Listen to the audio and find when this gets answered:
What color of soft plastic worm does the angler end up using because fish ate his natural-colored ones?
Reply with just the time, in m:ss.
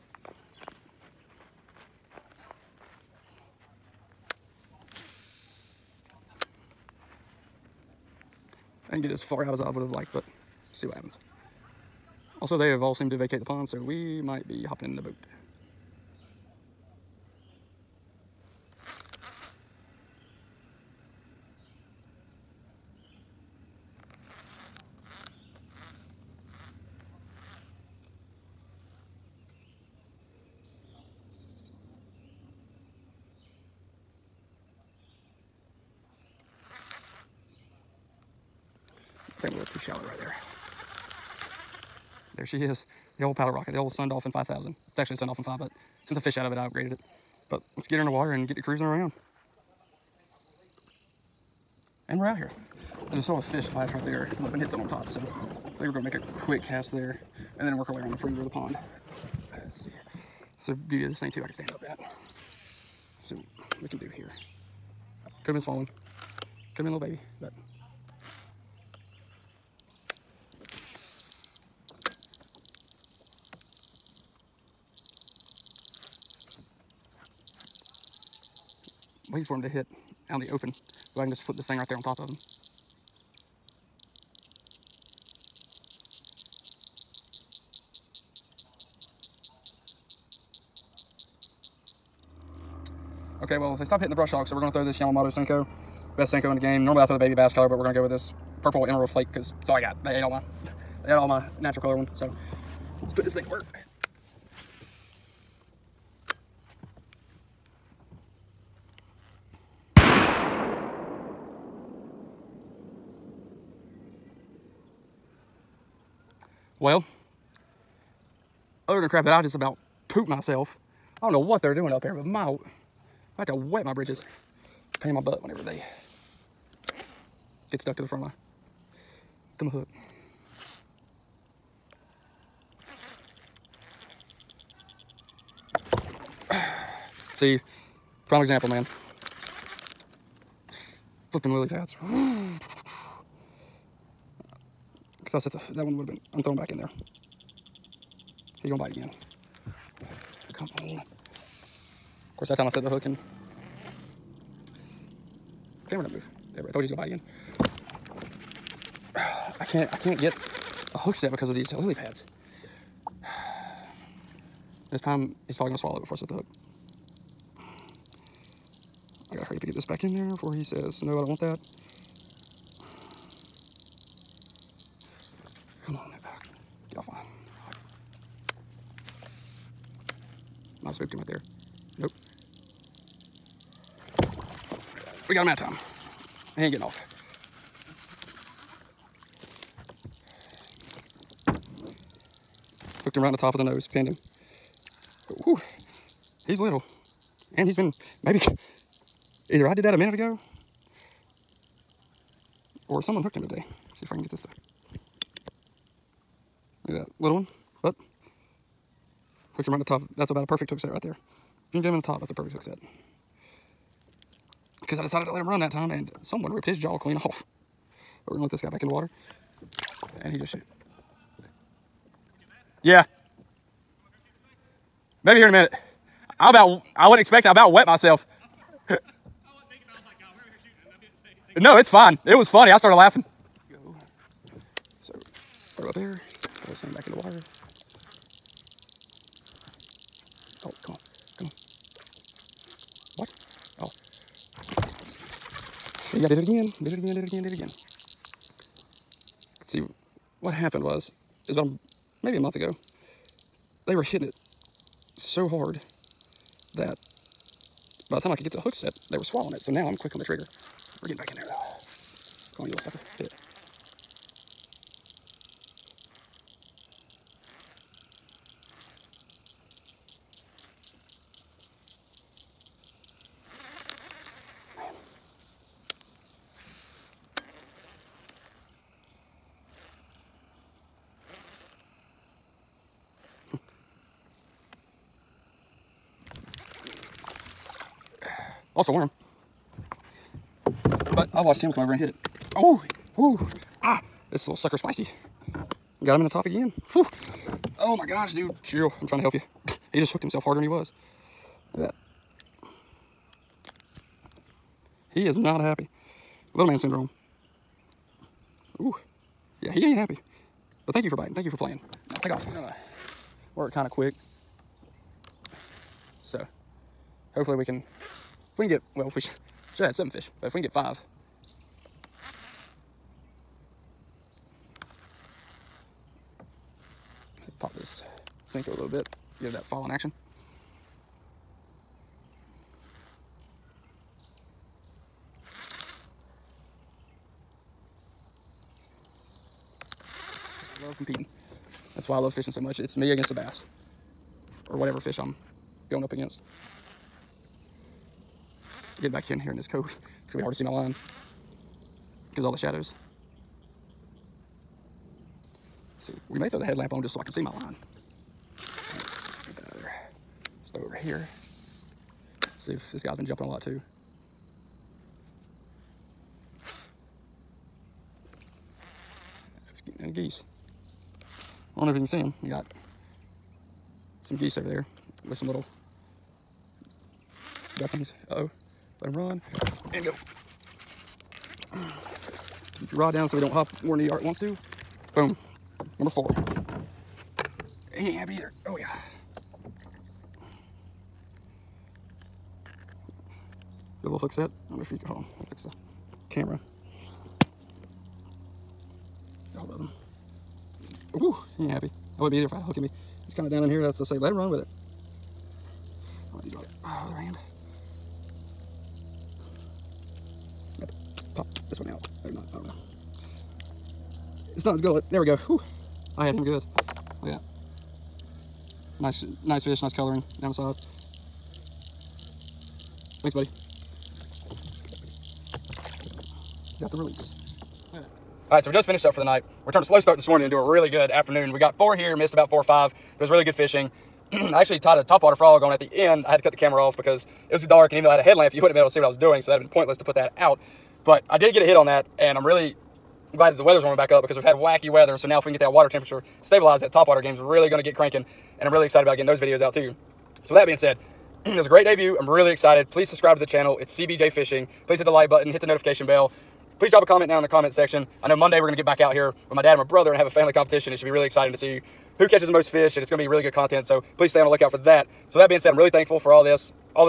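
1:38.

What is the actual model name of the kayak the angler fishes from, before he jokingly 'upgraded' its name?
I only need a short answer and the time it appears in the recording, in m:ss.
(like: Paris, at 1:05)
Sun Dolphin 5, at 0:45.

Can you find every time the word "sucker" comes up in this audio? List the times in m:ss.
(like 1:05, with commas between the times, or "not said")
4:22, 4:54.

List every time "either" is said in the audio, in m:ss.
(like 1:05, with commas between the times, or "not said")
3:19, 6:28, 6:42.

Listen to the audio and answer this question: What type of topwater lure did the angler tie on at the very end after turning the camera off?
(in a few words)
frog.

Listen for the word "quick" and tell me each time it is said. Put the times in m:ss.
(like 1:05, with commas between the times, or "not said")
0:56, 4:19, 5:13.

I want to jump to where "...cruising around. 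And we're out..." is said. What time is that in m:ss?
0:48.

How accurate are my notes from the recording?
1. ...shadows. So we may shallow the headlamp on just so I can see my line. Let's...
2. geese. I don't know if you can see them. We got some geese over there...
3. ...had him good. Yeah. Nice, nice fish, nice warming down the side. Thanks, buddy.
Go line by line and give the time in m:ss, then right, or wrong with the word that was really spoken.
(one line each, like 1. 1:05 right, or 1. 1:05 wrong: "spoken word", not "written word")
1. 5:52 wrong: "throw", not "shallow"
2. 6:10 right
3. 6:56 wrong: "coloring", not "warming".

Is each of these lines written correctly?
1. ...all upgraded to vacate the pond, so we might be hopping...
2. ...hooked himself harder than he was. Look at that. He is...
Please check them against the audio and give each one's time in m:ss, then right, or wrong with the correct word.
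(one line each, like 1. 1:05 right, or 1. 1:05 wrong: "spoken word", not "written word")
1. 0:12 wrong: "seemed", not "upgraded"
2. 5:00 right.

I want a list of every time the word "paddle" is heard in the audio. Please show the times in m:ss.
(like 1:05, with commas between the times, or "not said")
0:43.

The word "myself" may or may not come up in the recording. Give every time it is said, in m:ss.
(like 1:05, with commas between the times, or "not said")
2:00, 3:47.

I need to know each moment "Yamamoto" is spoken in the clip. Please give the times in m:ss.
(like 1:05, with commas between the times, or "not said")
1:34.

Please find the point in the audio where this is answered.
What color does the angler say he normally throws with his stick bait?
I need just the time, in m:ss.
1:37.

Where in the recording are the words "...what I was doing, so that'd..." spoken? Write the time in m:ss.
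7:18.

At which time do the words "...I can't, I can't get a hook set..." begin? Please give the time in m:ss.
2:39.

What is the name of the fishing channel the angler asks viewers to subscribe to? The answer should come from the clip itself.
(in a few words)
CBJ Fishing.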